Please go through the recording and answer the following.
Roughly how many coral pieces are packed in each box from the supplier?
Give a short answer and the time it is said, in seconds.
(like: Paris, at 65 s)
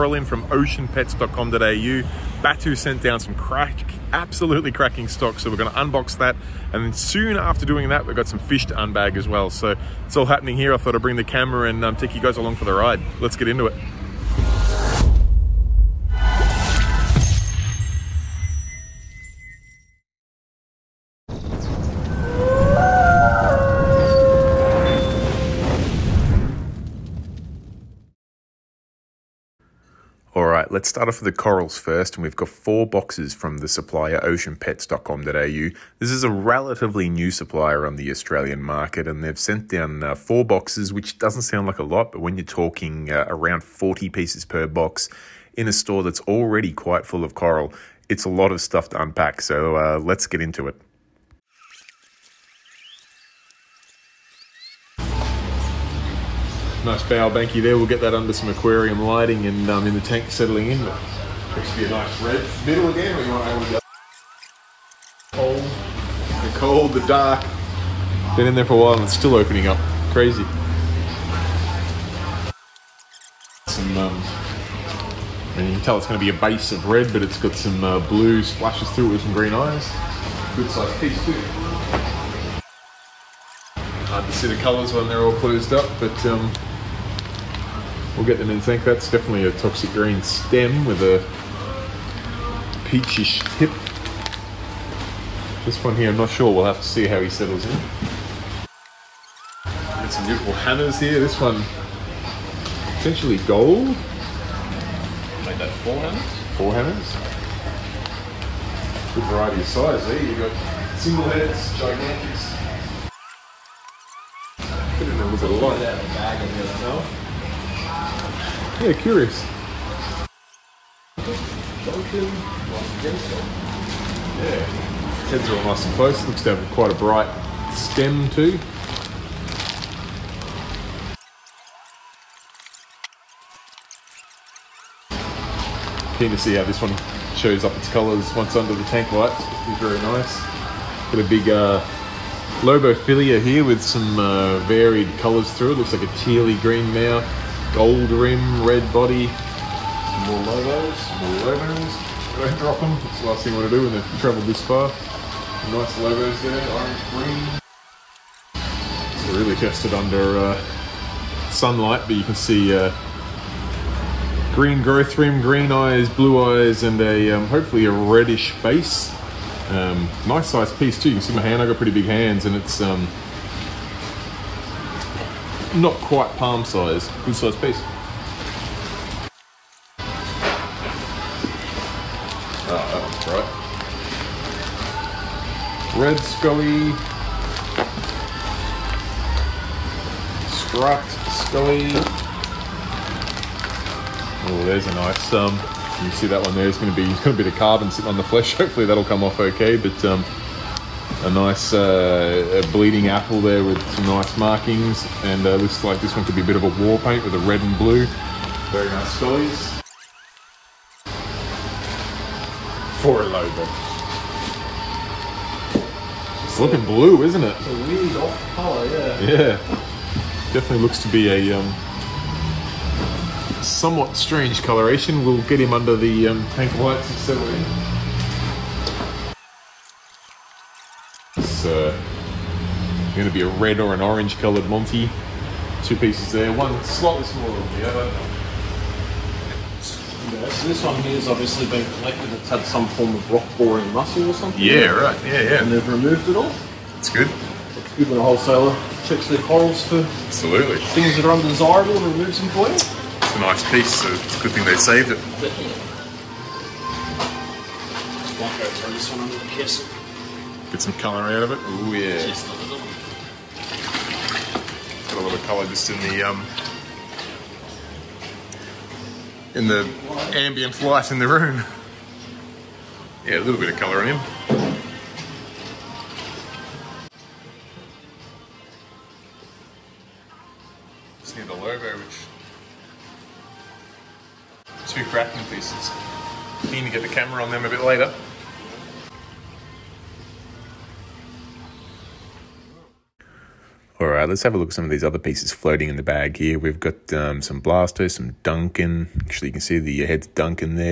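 40, at 43 s.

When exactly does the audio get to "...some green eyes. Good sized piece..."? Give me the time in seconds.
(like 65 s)
79 s.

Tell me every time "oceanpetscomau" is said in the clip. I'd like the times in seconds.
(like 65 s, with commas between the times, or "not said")
0 s, 34 s.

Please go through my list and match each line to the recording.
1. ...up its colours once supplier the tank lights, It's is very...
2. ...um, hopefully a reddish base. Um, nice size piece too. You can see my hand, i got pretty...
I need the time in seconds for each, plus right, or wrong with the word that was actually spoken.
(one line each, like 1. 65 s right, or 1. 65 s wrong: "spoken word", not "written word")
1. 137 s wrong: "under", not "supplier"
2. 167 s right.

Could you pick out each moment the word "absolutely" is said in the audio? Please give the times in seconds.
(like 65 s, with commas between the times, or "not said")
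4 s, 250 s.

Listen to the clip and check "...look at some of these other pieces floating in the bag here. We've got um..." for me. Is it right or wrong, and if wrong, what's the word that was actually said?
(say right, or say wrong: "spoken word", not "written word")
right.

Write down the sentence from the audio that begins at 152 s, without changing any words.
Don't drop them, it's the last thing you want to do when they've travelled this far.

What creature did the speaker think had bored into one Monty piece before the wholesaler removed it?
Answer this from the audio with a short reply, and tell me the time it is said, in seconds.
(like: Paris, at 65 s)
rock boring mussel, at 243 s.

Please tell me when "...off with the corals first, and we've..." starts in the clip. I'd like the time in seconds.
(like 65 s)
31 s.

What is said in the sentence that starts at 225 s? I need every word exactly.
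We'll get him under the um, tank lights and settle in.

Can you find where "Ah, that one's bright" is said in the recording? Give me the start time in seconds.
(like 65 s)
182 s.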